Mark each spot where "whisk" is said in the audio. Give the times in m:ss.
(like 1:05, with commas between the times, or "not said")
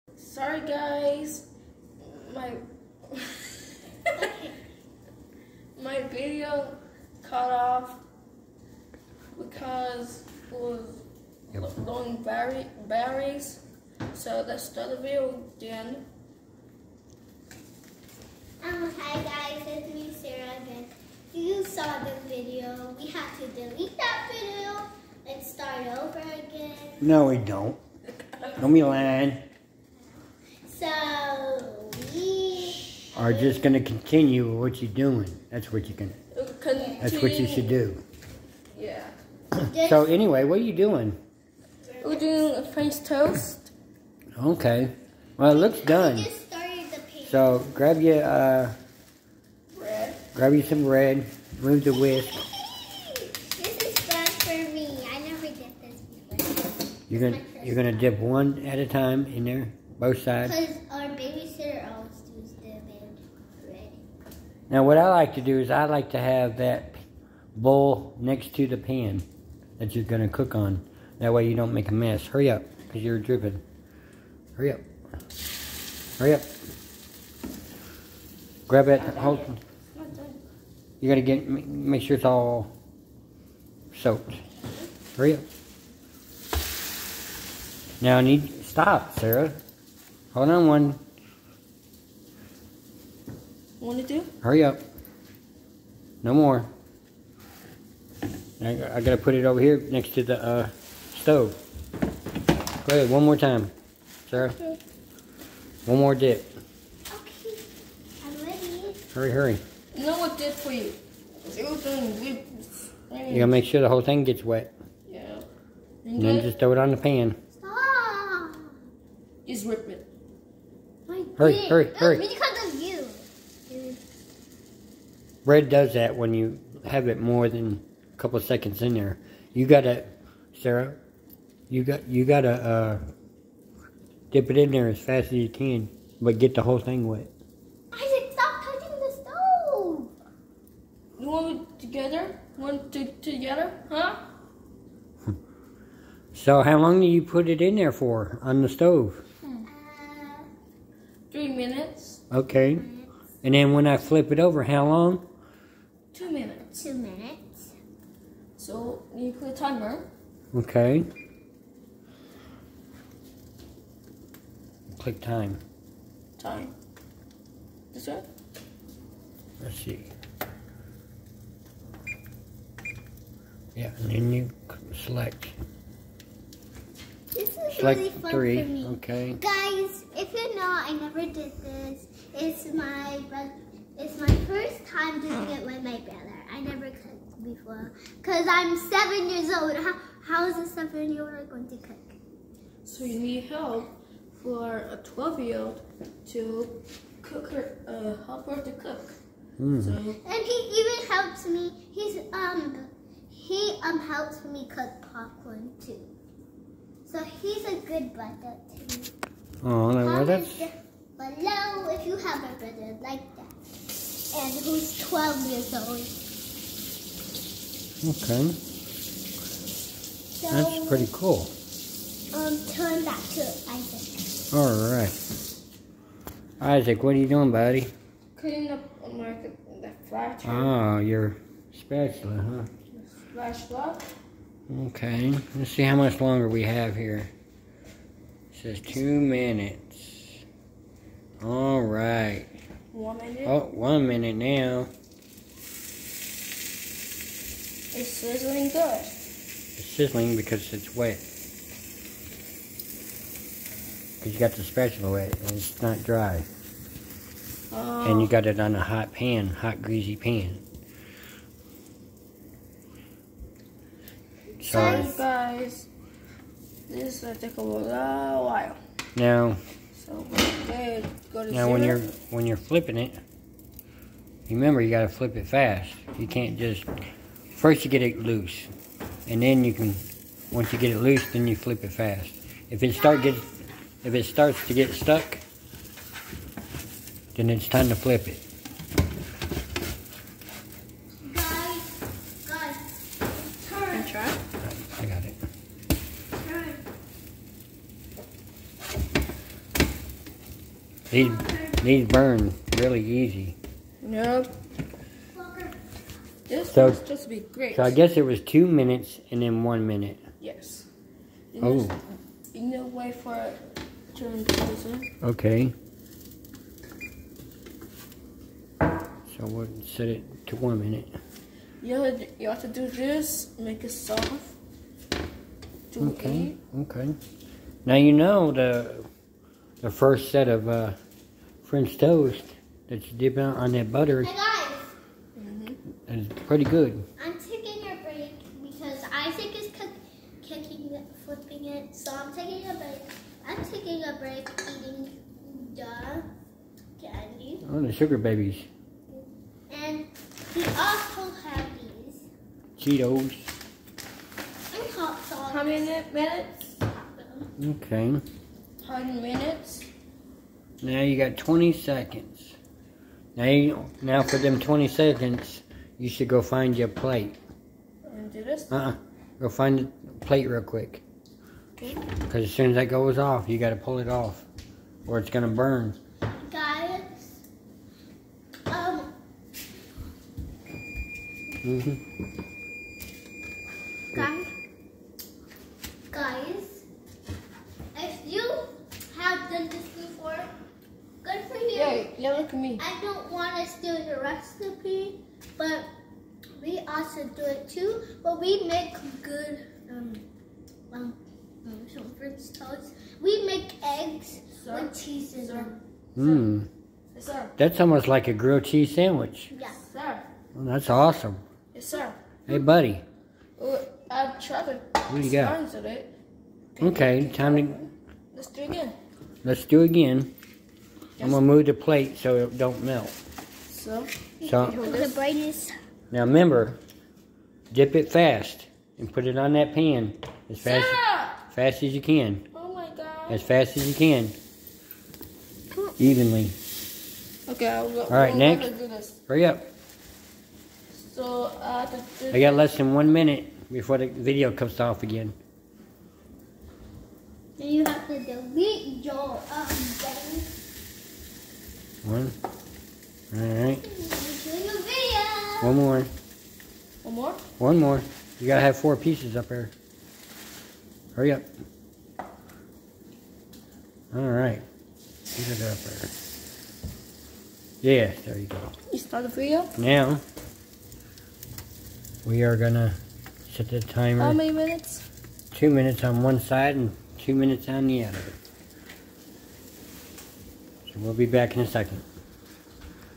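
0:51.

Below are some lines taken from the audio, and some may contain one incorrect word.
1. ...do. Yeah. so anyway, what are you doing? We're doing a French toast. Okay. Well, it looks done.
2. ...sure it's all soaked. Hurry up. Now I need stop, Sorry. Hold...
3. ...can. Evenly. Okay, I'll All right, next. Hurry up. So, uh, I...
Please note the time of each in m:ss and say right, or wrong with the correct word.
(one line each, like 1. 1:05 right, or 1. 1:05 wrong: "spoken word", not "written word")
1. 0:37 right
2. 1:22 wrong: "Sarah", not "Sorry"
3. 7:13 right.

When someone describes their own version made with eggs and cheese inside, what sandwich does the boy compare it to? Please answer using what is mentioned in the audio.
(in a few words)
Grilled cheese sandwich.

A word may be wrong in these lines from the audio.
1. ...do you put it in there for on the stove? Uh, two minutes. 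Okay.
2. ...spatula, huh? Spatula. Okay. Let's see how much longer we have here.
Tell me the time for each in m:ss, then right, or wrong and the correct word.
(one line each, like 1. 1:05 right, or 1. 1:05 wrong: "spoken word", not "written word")
1. 2:27 wrong: "three", not "two"
2. 3:51 right.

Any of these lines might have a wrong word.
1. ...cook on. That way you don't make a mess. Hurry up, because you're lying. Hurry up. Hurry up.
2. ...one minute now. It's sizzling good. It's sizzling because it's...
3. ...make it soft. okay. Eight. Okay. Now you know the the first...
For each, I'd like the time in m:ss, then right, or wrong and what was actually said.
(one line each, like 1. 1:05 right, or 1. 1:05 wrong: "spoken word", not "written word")
1. 1:10 wrong: "dripping", not "lying"
2. 4:03 right
3. 5:23 right.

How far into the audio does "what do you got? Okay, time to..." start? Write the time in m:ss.
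6:54.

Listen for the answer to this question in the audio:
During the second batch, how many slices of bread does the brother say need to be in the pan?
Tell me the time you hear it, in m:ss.
7:38.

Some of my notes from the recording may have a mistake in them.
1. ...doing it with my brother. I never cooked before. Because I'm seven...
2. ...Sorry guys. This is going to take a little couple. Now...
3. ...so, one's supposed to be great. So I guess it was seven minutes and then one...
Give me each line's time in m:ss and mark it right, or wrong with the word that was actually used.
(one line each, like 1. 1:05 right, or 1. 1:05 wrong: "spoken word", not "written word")
1. 3:05 right
2. 4:25 wrong: "while", not "couple"
3. 5:06 wrong: "two", not "seven".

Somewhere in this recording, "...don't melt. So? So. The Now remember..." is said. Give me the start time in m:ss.
7:02.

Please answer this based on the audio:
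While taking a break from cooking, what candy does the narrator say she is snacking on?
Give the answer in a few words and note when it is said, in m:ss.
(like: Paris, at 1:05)
Sugar Babies, at 5:47.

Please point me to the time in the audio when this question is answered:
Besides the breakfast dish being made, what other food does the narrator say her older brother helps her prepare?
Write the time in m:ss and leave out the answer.
3:25.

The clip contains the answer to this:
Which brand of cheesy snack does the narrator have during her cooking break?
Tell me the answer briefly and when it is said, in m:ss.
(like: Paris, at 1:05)
Cheetos, at 5:52.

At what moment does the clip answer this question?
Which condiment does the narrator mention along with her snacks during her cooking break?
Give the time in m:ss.
5:54.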